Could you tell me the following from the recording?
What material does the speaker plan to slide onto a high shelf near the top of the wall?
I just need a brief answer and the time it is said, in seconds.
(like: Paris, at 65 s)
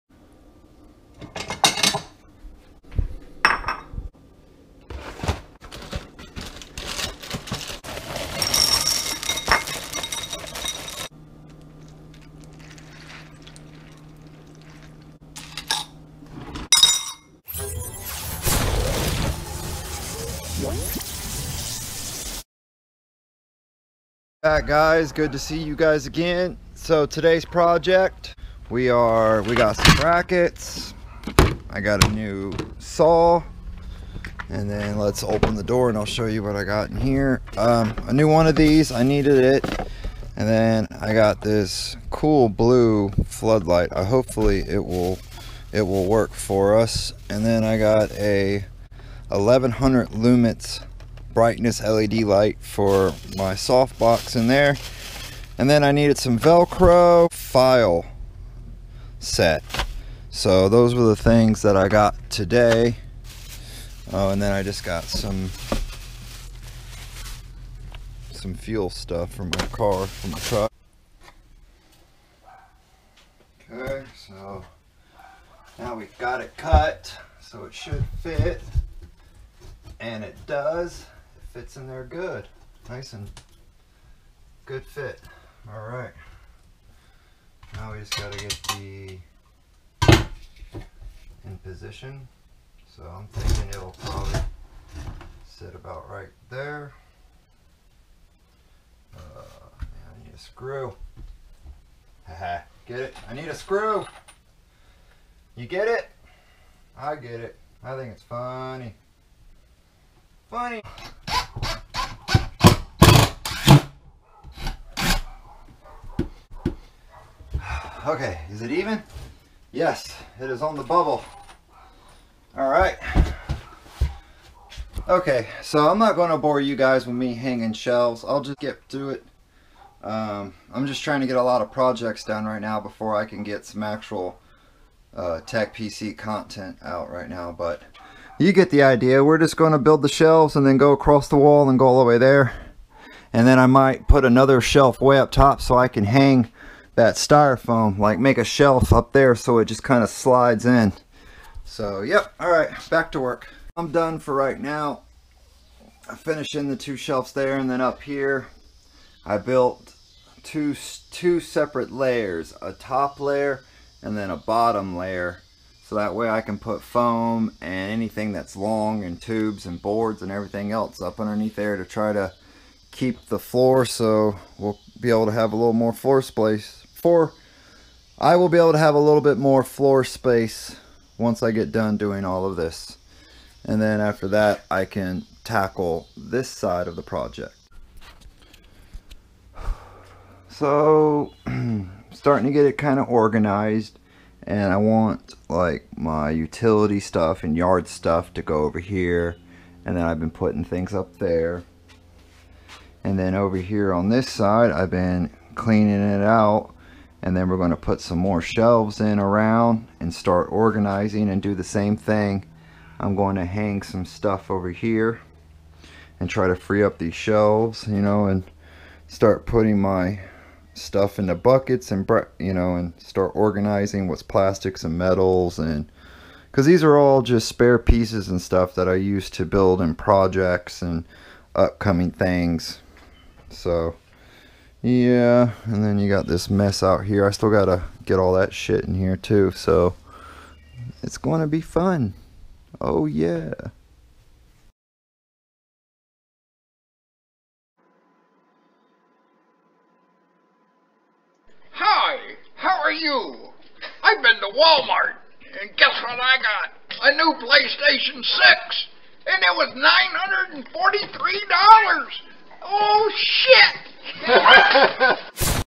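Styrofoam, at 147 s.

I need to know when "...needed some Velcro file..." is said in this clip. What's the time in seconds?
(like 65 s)
55 s.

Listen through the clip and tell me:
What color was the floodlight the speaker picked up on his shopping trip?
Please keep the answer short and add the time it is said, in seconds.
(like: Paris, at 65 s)
Blue, at 42 s.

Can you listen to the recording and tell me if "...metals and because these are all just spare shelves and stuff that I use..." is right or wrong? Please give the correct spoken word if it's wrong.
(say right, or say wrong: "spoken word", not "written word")
wrong: "pieces", not "shelves".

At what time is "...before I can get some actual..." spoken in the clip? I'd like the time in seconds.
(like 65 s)
132 s.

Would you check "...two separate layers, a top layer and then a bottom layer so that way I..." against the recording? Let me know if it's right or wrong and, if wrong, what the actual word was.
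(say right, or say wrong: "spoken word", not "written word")
right.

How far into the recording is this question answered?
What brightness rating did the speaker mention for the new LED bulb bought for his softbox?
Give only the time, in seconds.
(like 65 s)
49 s.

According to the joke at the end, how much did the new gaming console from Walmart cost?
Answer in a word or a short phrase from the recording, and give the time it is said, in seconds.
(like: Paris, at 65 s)
$943, at 260 s.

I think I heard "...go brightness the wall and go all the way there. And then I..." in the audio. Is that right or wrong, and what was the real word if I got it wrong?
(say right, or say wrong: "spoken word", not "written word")
wrong: "across", not "brightness".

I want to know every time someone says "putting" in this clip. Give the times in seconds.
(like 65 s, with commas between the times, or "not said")
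200 s, 219 s.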